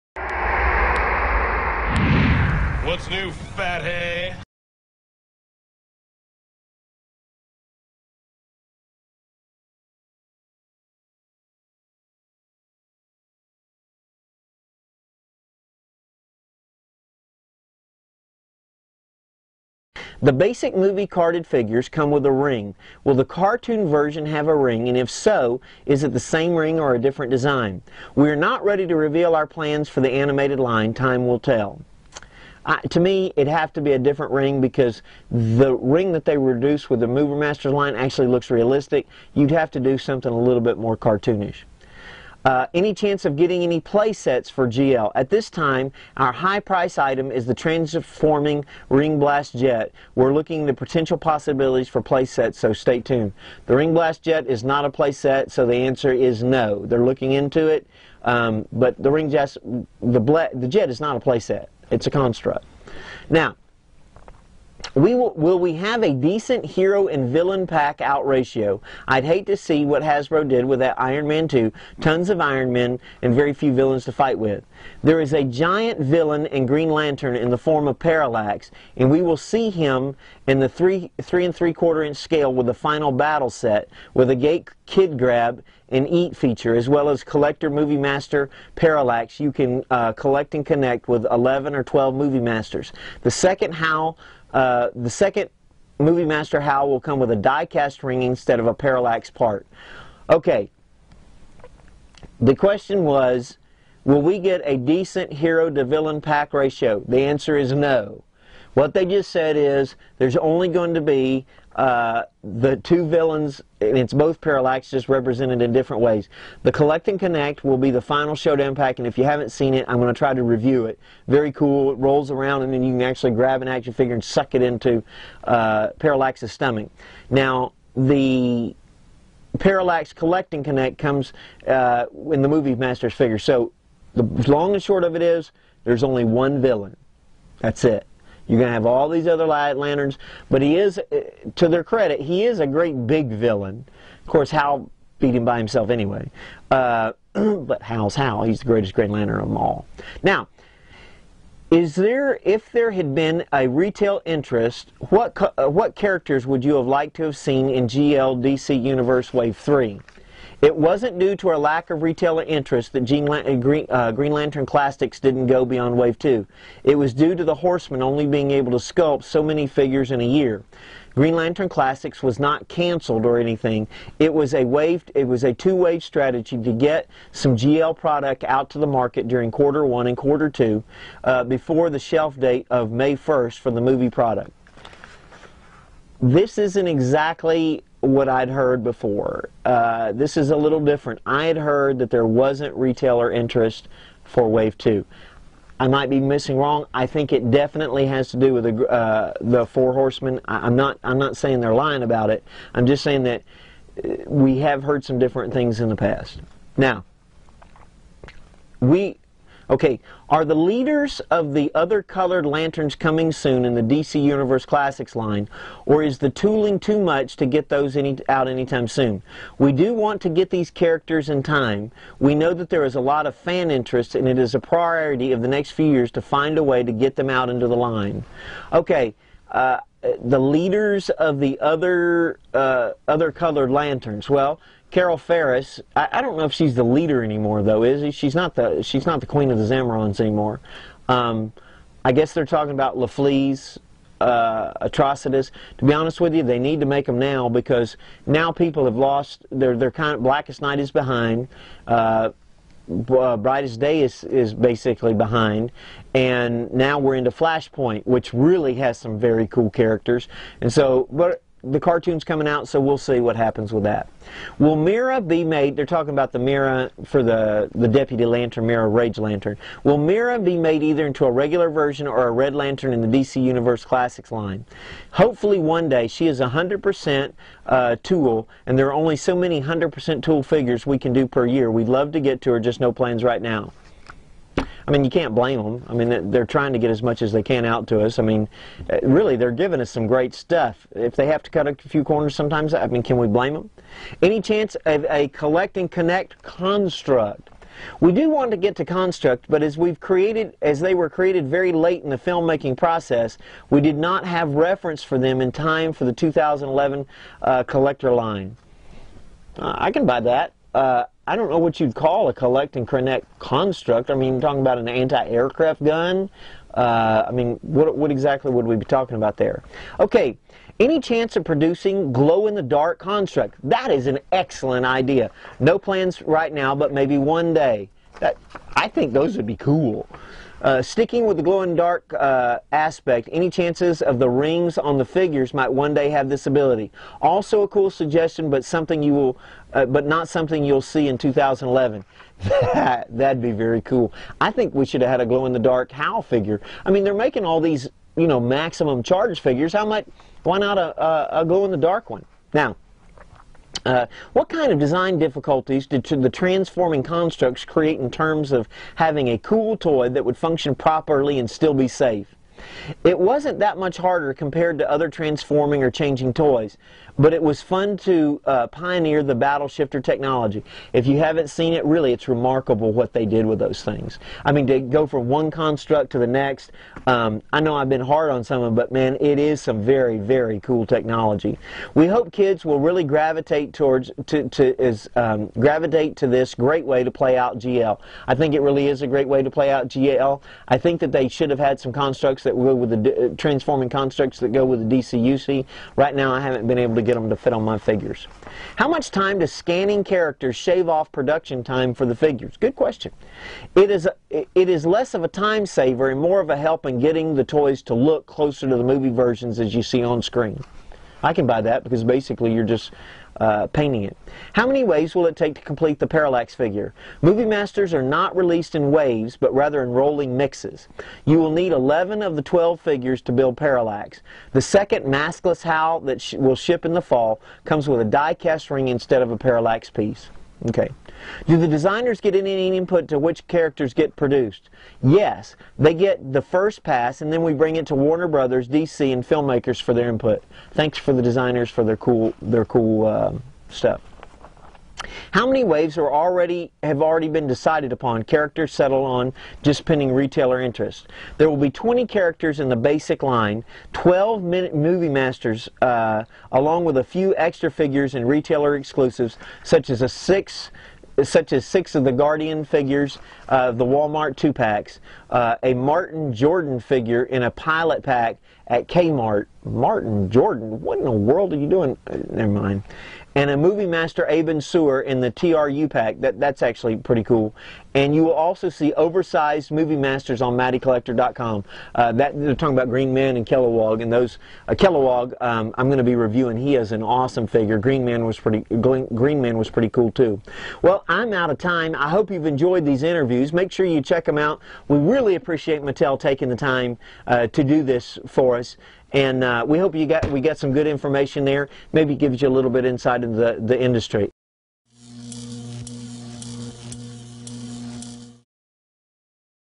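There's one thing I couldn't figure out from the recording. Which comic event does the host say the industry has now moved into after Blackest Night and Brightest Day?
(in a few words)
Flashpoint.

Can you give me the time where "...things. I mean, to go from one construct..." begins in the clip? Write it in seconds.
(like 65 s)
373 s.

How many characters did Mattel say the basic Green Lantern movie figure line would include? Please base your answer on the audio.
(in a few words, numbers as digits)
20.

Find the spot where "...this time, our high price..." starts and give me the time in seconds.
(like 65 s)
45 s.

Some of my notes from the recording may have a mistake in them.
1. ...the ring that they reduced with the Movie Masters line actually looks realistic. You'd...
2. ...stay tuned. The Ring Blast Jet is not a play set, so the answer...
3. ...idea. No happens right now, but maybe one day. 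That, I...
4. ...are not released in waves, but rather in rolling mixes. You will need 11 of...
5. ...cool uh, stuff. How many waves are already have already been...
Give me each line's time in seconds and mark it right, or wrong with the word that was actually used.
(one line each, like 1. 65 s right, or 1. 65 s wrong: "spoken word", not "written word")
1. 35 s right
2. 52 s right
3. 324 s wrong: "plans", not "happens"
4. 417 s right
5. 442 s right.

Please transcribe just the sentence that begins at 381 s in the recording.
We hope kids will really gravitate towards to, to is um, gravitate to this great way to play out GL.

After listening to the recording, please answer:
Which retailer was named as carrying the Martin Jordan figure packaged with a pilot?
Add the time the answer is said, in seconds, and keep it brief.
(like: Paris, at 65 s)
Kmart, at 468 s.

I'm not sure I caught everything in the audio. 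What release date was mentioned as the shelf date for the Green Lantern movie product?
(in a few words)
May 1st.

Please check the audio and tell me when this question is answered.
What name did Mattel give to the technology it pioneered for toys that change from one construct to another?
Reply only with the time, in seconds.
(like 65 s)
369 s.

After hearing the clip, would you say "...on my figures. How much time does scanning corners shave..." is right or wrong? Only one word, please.
wrong.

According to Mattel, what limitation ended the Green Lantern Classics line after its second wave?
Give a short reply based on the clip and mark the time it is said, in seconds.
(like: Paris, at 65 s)
the Horsemen, at 167 s.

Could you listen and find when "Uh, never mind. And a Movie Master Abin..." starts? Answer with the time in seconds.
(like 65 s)
472 s.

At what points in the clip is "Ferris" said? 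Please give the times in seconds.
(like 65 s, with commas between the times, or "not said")
235 s.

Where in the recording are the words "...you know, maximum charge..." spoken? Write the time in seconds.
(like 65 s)
348 s.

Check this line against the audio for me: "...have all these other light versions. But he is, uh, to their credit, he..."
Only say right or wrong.
wrong.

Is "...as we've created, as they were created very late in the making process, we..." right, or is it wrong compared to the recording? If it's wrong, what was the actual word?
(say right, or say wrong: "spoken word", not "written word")
wrong: "filmmaking", not "making".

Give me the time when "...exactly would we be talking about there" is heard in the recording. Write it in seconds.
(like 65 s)
318 s.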